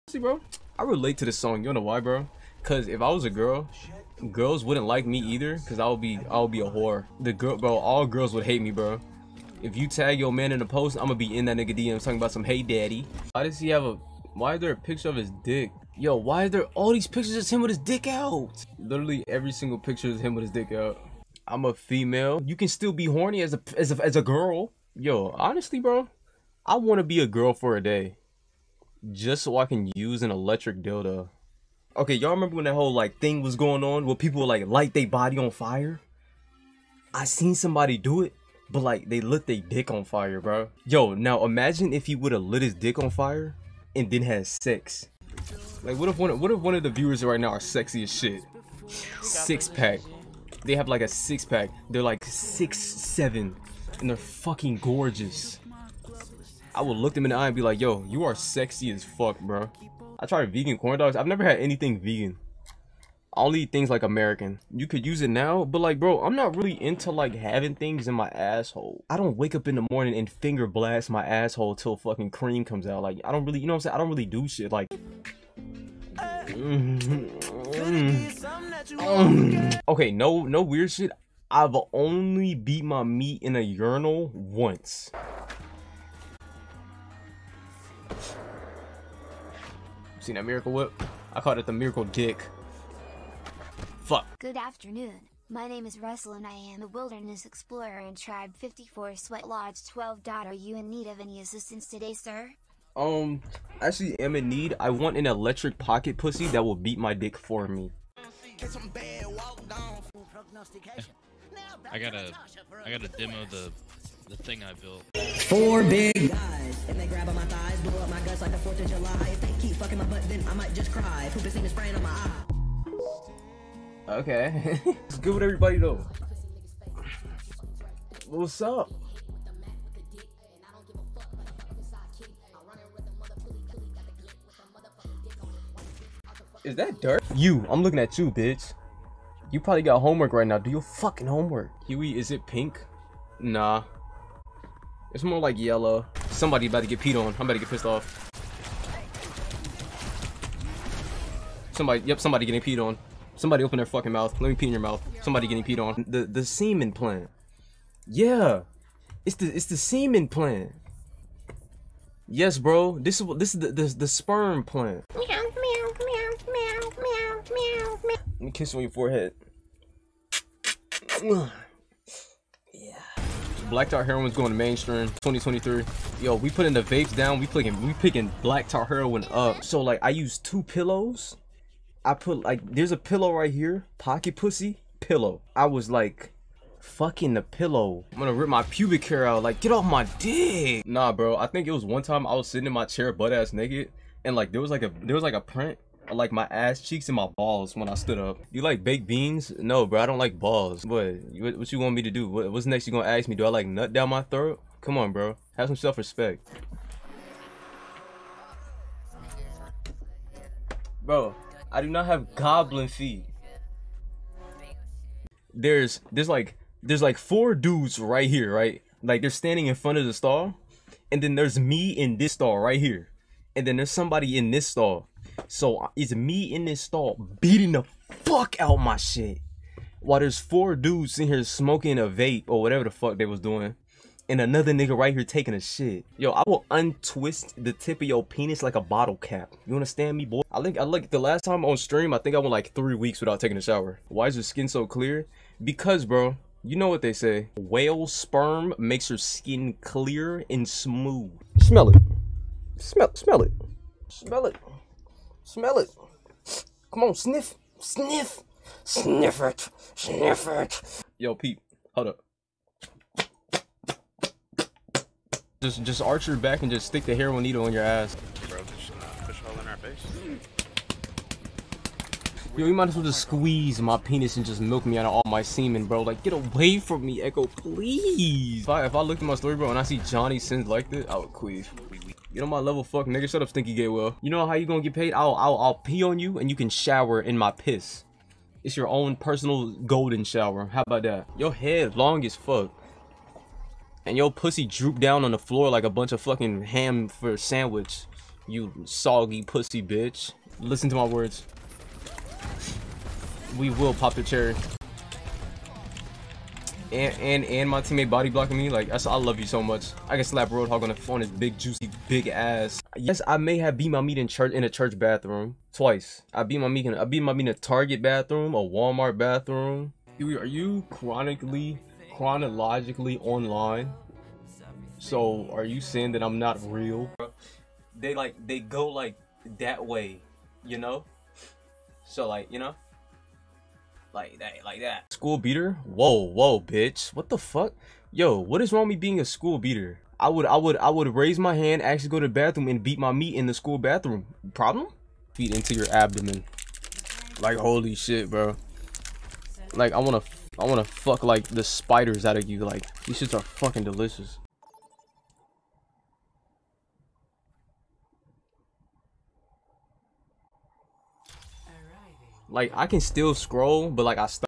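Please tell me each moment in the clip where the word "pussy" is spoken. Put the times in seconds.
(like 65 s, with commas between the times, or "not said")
106 s, 184 s, 294 s, 299 s.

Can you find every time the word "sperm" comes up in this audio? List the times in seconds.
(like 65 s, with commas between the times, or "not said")
164 s, 248 s.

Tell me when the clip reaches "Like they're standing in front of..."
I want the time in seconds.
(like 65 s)
219 s.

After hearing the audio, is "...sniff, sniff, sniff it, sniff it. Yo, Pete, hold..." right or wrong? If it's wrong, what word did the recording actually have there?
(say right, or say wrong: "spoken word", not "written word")
right.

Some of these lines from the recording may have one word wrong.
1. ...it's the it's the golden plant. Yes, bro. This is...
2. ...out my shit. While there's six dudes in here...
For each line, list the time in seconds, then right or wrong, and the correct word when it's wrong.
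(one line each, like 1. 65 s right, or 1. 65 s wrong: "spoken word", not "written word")
1. 159 s wrong: "semen", not "golden"
2. 228 s wrong: "four", not "six".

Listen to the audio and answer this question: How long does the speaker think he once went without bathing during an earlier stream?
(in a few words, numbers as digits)
3 weeks.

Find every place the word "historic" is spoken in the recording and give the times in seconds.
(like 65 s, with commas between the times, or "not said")
not said.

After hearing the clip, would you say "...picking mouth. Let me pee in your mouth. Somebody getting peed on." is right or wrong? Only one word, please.
wrong.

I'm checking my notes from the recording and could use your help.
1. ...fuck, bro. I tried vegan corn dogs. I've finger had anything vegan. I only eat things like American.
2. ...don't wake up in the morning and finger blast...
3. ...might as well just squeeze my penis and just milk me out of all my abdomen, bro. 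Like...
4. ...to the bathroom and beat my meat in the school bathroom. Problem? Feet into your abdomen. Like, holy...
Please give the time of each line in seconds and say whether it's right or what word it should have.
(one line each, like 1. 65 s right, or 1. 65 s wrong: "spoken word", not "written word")
1. 59 s wrong: "never", not "finger"
2. 69 s right
3. 272 s wrong: "semen", not "abdomen"
4. 342 s right.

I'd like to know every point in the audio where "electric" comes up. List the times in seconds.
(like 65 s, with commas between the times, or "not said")
30 s, 105 s.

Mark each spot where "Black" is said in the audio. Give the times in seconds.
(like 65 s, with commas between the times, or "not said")
173 s, 178 s.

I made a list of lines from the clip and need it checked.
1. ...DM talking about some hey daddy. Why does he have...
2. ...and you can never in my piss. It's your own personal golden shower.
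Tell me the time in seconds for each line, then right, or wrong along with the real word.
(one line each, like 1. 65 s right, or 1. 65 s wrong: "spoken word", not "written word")
1. 11 s right
2. 286 s wrong: "shower", not "never".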